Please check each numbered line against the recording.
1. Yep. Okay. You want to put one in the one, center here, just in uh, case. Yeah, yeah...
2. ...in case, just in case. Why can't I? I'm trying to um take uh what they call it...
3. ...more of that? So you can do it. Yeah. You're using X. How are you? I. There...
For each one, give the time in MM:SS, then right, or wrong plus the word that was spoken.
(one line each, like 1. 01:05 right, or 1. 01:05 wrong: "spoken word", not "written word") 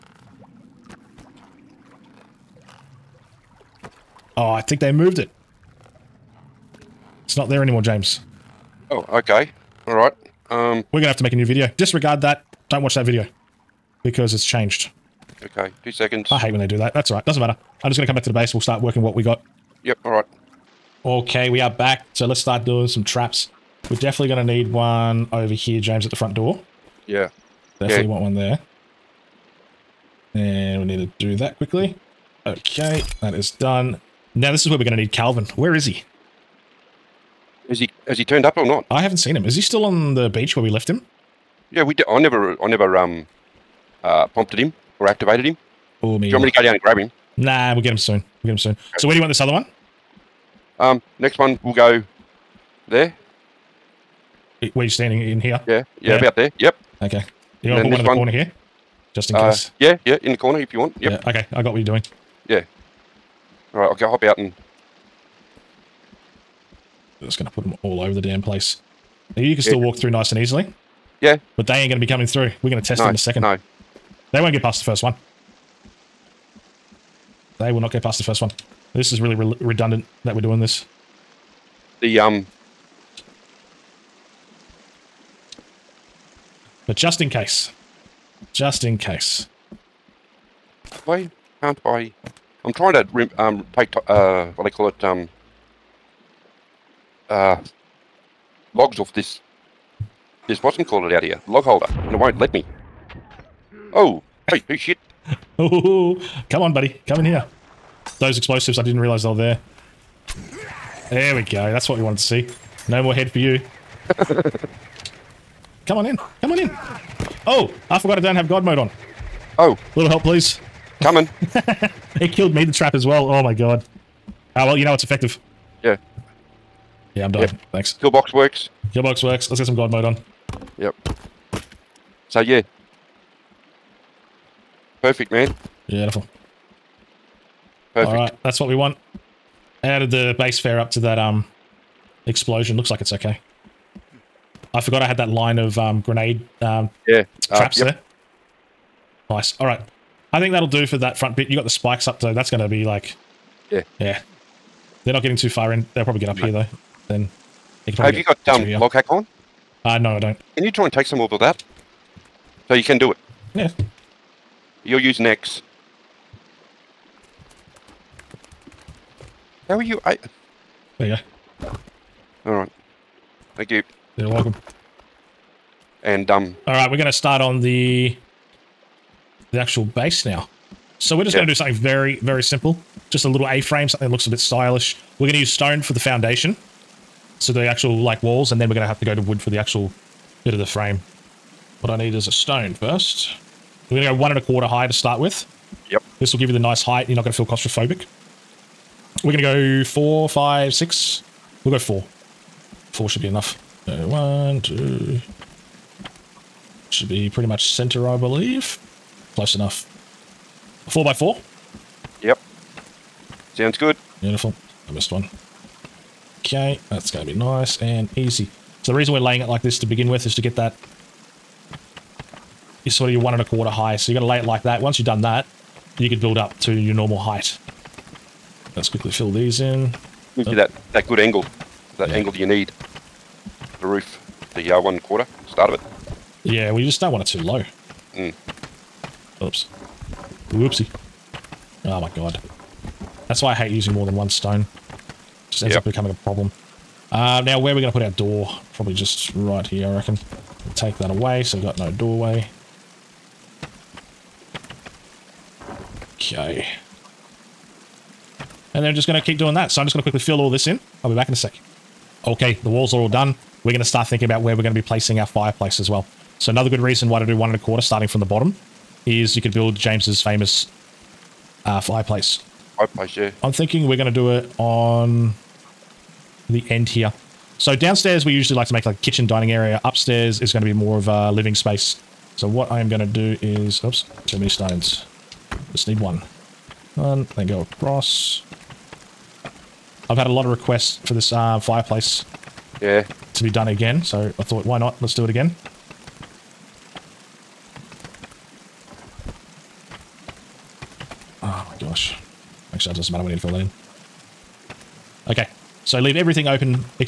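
1. 00:56 wrong: "corner", not "center"
2. 01:27 right
3. 02:41 right.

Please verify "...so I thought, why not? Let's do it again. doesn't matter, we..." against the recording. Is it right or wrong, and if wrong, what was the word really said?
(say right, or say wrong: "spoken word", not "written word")
right.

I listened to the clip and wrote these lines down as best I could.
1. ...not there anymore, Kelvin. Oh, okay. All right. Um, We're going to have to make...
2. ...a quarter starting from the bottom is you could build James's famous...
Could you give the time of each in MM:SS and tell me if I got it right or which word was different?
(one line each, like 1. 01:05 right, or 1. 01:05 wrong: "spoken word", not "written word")
1. 00:07 wrong: "James", not "Kelvin"
2. 04:27 right.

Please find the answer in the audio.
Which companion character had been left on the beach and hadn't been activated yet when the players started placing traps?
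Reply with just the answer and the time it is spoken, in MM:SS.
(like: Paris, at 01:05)
Kelvin, at 00:35.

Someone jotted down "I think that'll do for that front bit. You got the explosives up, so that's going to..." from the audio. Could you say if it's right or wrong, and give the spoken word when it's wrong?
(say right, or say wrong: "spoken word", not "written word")
wrong: "spikes", not "explosives".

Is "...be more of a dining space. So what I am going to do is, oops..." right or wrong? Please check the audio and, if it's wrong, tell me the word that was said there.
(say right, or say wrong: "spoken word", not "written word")
wrong: "living", not "dining".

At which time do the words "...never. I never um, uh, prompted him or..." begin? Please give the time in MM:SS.
00:42.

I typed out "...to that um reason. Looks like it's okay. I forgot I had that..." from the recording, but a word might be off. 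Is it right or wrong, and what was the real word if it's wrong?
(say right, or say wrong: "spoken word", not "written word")
wrong: "explosion", not "reason".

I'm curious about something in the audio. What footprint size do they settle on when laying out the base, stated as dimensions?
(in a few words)
4 by 4.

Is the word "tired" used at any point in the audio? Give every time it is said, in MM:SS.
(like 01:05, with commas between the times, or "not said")
not said.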